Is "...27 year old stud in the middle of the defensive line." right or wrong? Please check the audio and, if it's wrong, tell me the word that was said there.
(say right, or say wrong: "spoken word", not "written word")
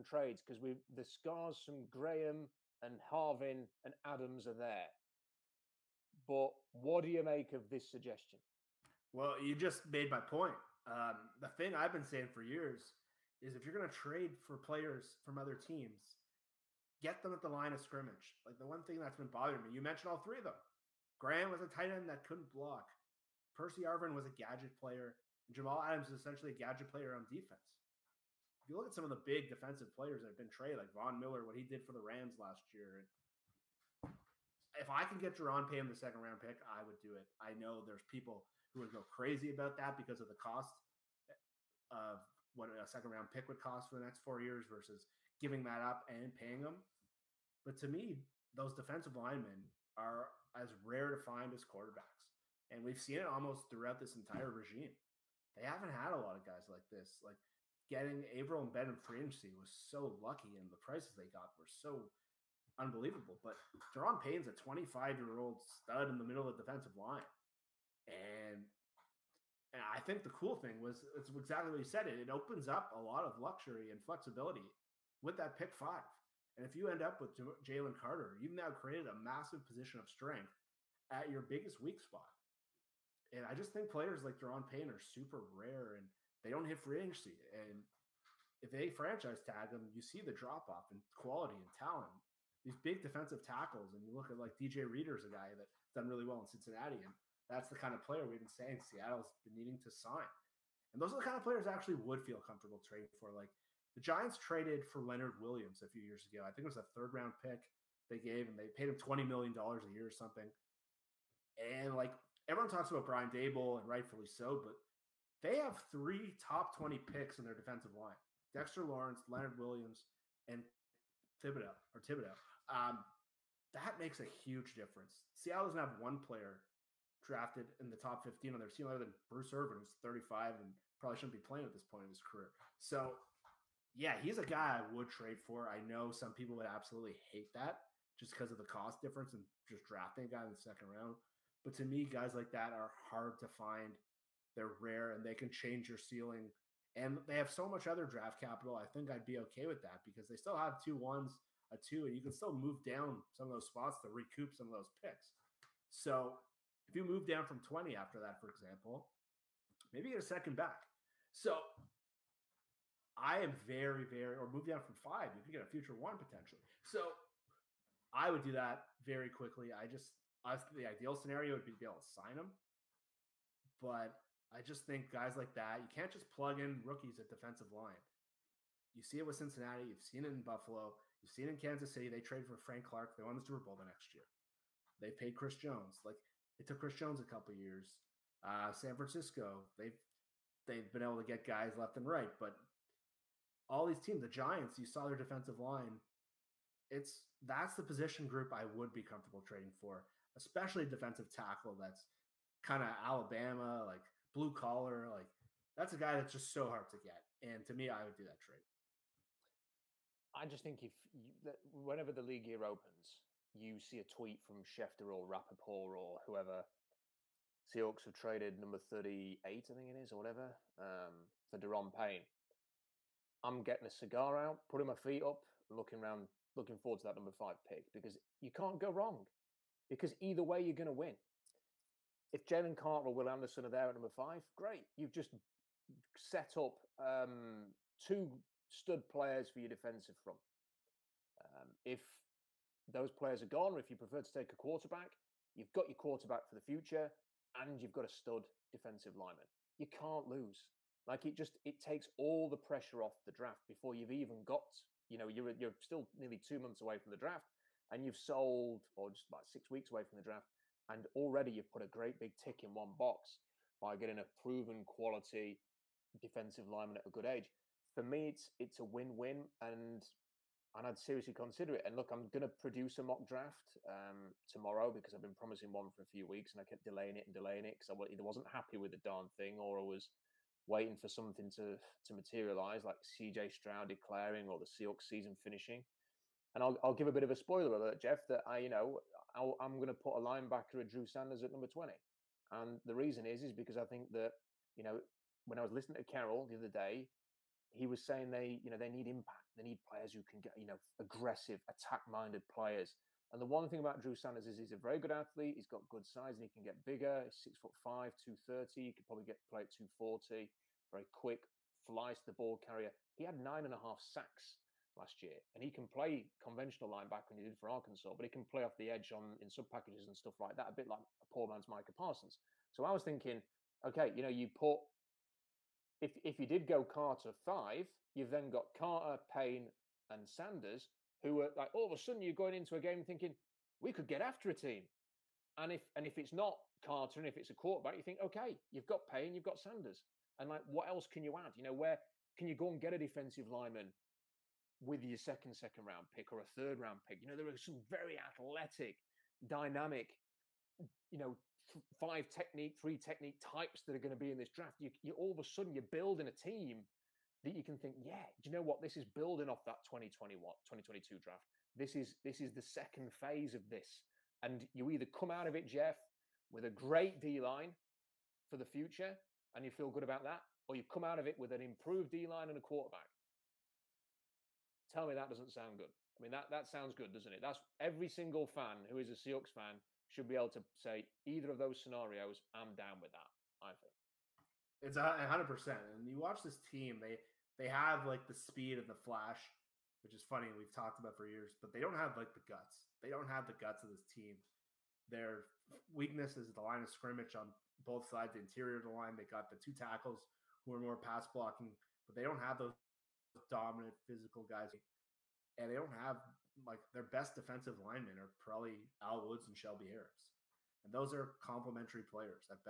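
wrong: "25", not "27".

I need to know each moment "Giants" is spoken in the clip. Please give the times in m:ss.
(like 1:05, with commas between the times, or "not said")
1:43, 3:14.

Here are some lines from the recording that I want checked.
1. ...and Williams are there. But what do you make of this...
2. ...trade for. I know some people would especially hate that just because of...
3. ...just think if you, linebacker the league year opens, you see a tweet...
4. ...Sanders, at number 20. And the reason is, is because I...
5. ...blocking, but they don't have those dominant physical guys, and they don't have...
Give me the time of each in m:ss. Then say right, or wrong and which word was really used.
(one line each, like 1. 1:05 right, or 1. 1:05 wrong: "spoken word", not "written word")
1. 0:03 wrong: "Adams", not "Williams"
2. 2:15 wrong: "absolutely", not "especially"
3. 3:30 wrong: "whenever", not "linebacker"
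4. 4:51 right
5. 6:41 right.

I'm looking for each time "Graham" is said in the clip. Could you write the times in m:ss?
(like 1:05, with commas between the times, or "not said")
0:01, 0:21.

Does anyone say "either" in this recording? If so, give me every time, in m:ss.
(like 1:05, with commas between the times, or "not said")
3:50, 4:38, 6:04, 6:21.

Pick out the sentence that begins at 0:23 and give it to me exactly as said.
Percy Harvin was a gadget player.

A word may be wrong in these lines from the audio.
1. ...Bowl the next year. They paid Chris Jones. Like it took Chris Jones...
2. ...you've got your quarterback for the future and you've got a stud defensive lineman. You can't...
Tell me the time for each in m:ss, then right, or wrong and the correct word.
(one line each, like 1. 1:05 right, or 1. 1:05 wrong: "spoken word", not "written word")
1. 3:03 right
2. 4:05 right.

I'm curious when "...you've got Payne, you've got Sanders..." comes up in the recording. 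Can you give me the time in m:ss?
5:38.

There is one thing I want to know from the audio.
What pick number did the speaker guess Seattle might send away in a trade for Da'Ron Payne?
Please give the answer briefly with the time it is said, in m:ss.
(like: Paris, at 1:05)
38, at 3:38.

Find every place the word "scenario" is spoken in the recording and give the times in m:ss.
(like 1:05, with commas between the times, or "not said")
2:51, 6:21.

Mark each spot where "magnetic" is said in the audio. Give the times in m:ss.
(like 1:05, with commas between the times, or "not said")
not said.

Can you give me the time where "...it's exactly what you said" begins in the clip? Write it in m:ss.
1:11.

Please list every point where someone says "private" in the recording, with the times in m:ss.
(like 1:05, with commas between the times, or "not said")
not said.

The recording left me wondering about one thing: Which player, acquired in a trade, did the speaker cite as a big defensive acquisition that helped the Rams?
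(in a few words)
Von Miller.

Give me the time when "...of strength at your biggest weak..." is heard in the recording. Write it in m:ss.
1:19.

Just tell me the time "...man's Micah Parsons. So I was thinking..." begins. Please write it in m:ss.
5:21.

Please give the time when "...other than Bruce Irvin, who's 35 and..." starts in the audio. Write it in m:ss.
2:08.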